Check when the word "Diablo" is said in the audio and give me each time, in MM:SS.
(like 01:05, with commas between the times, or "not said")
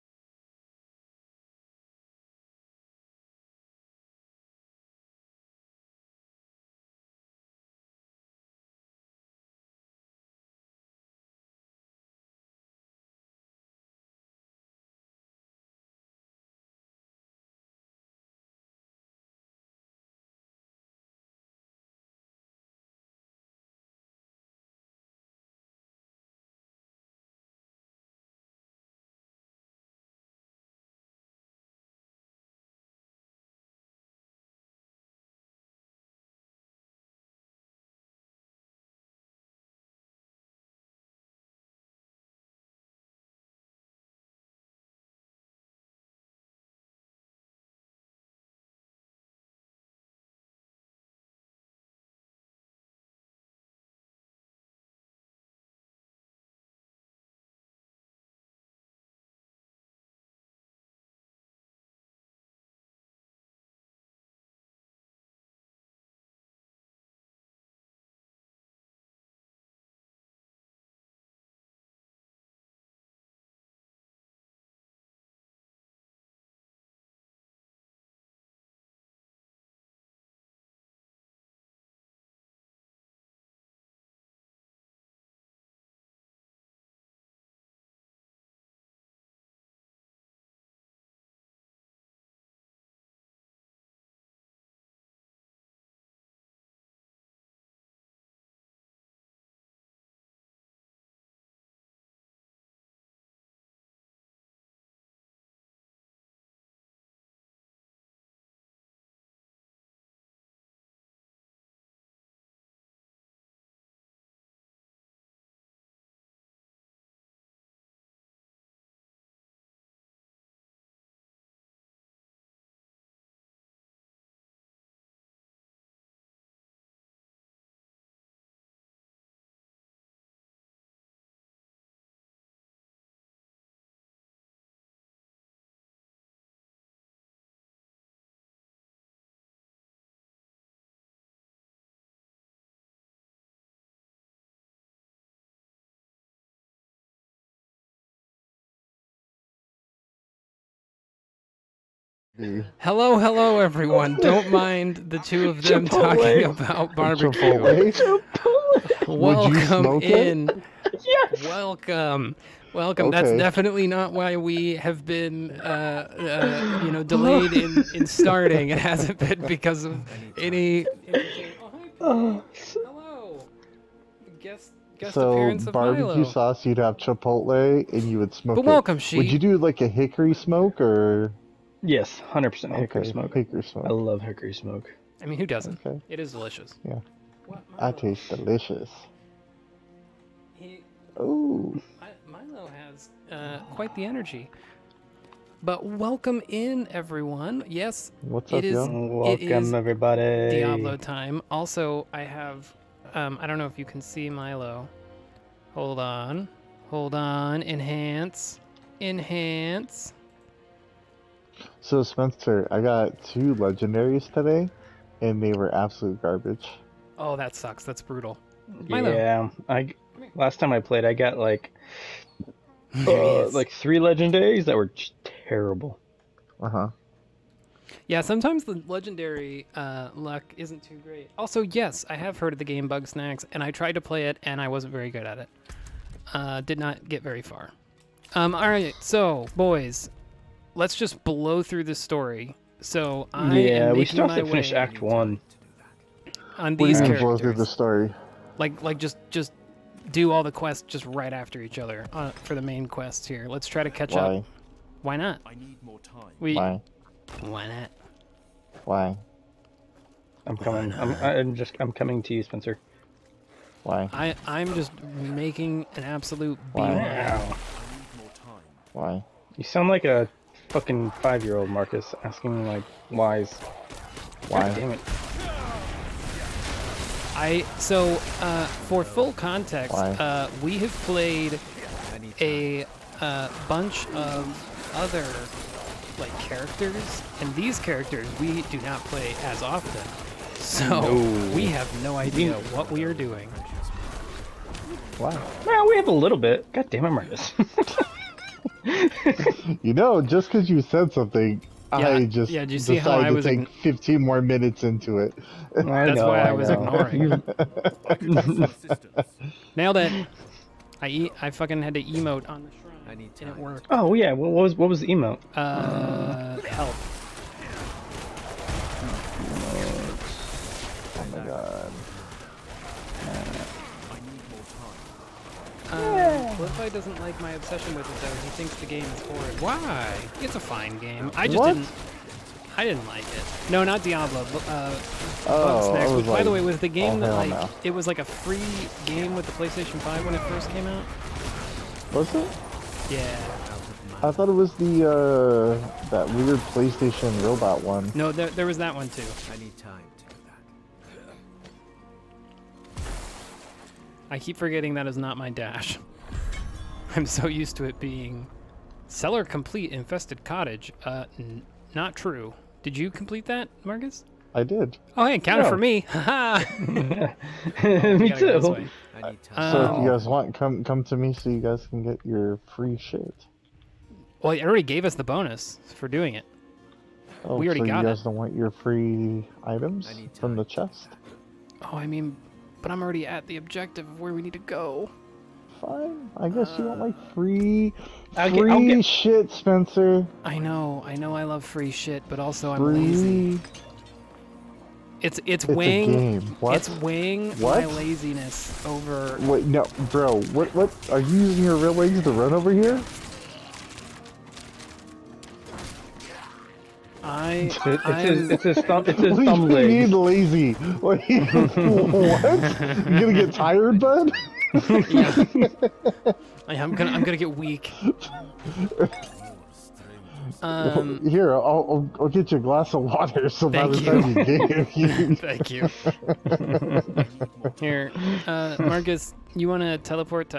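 03:20, 05:34.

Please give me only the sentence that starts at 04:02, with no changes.
So I yeah, we still have to finish Act One.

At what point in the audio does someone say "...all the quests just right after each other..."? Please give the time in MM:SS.
04:10.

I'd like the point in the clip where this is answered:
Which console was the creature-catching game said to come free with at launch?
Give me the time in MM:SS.
05:39.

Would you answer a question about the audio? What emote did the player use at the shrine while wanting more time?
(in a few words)
Help.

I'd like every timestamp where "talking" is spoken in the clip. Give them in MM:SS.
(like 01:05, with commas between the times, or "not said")
02:36.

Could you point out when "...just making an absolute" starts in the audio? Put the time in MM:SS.
04:24.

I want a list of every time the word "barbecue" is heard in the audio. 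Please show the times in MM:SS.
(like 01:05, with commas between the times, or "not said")
02:36, 02:55.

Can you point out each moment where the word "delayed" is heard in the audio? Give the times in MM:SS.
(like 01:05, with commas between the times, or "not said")
02:47.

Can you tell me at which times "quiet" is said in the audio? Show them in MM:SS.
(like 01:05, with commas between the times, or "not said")
not said.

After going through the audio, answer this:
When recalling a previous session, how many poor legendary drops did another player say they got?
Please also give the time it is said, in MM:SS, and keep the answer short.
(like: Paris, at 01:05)
3, at 03:43.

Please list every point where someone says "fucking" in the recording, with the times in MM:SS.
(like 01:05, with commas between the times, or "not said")
04:30, 05:11.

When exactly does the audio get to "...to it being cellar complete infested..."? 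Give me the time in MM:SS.
05:57.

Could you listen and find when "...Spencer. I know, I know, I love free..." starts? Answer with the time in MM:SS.
06:29.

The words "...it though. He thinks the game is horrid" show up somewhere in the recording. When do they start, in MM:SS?
05:28.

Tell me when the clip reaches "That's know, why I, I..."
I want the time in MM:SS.
05:05.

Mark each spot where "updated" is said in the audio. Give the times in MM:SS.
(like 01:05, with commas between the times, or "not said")
not said.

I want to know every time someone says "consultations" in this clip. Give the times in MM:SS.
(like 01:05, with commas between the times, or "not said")
not said.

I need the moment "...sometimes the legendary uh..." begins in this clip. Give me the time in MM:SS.
03:48.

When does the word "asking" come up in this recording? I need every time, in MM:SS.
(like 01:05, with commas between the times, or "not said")
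04:32.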